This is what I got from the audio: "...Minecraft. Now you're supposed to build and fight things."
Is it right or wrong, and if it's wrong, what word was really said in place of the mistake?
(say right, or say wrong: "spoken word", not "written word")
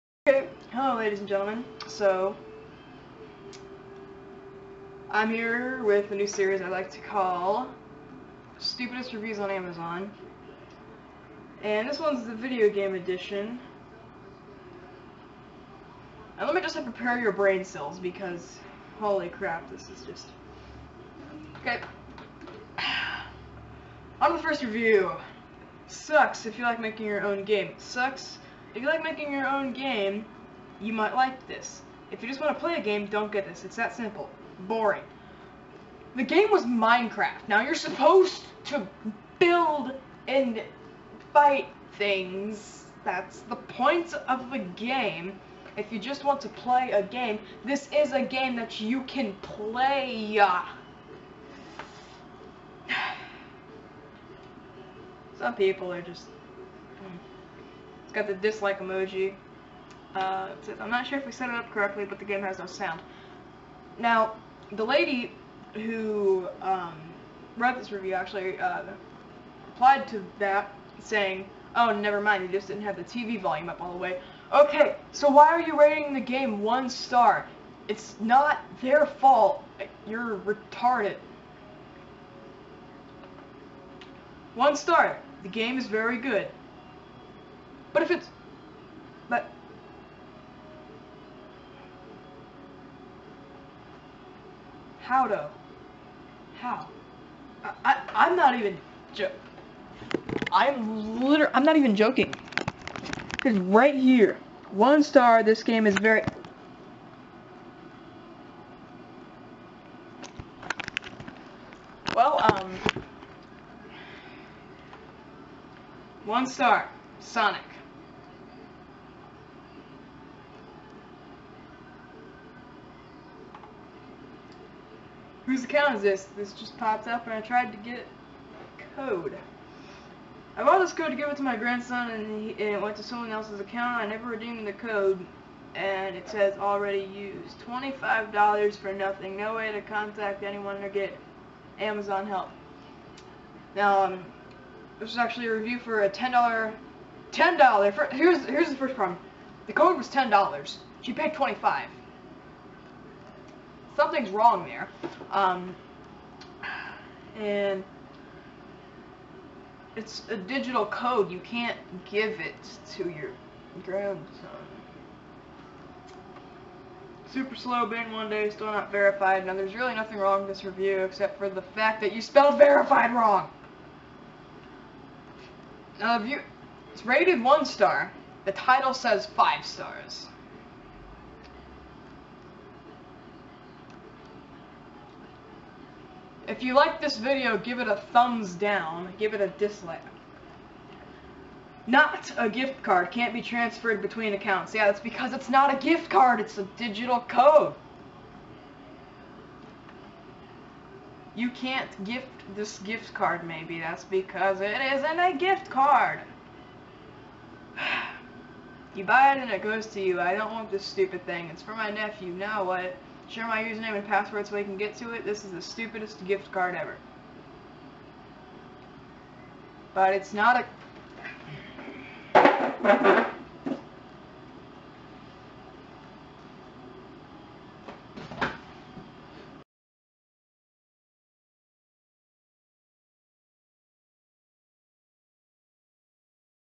right.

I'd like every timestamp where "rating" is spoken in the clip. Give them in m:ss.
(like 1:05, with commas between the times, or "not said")
1:15.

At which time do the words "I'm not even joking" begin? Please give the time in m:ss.
1:41.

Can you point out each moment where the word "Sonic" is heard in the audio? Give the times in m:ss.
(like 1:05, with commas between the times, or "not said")
1:57.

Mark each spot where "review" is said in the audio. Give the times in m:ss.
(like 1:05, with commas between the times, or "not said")
0:09, 0:24, 1:07, 2:25, 2:50.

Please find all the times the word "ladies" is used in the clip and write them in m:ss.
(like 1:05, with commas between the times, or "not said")
0:00.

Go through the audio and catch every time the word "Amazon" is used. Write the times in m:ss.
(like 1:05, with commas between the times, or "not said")
0:09, 2:21.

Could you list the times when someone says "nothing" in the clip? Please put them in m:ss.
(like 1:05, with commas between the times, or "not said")
2:18, 2:49.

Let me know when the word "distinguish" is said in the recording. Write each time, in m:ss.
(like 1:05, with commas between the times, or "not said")
not said.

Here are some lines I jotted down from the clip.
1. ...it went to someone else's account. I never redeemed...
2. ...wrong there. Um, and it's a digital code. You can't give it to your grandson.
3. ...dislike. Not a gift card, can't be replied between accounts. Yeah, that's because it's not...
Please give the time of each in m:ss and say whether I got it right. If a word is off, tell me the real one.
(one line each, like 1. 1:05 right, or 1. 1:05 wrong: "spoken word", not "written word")
1. 2:12 right
2. 2:34 right
3. 3:09 wrong: "transferred", not "replied".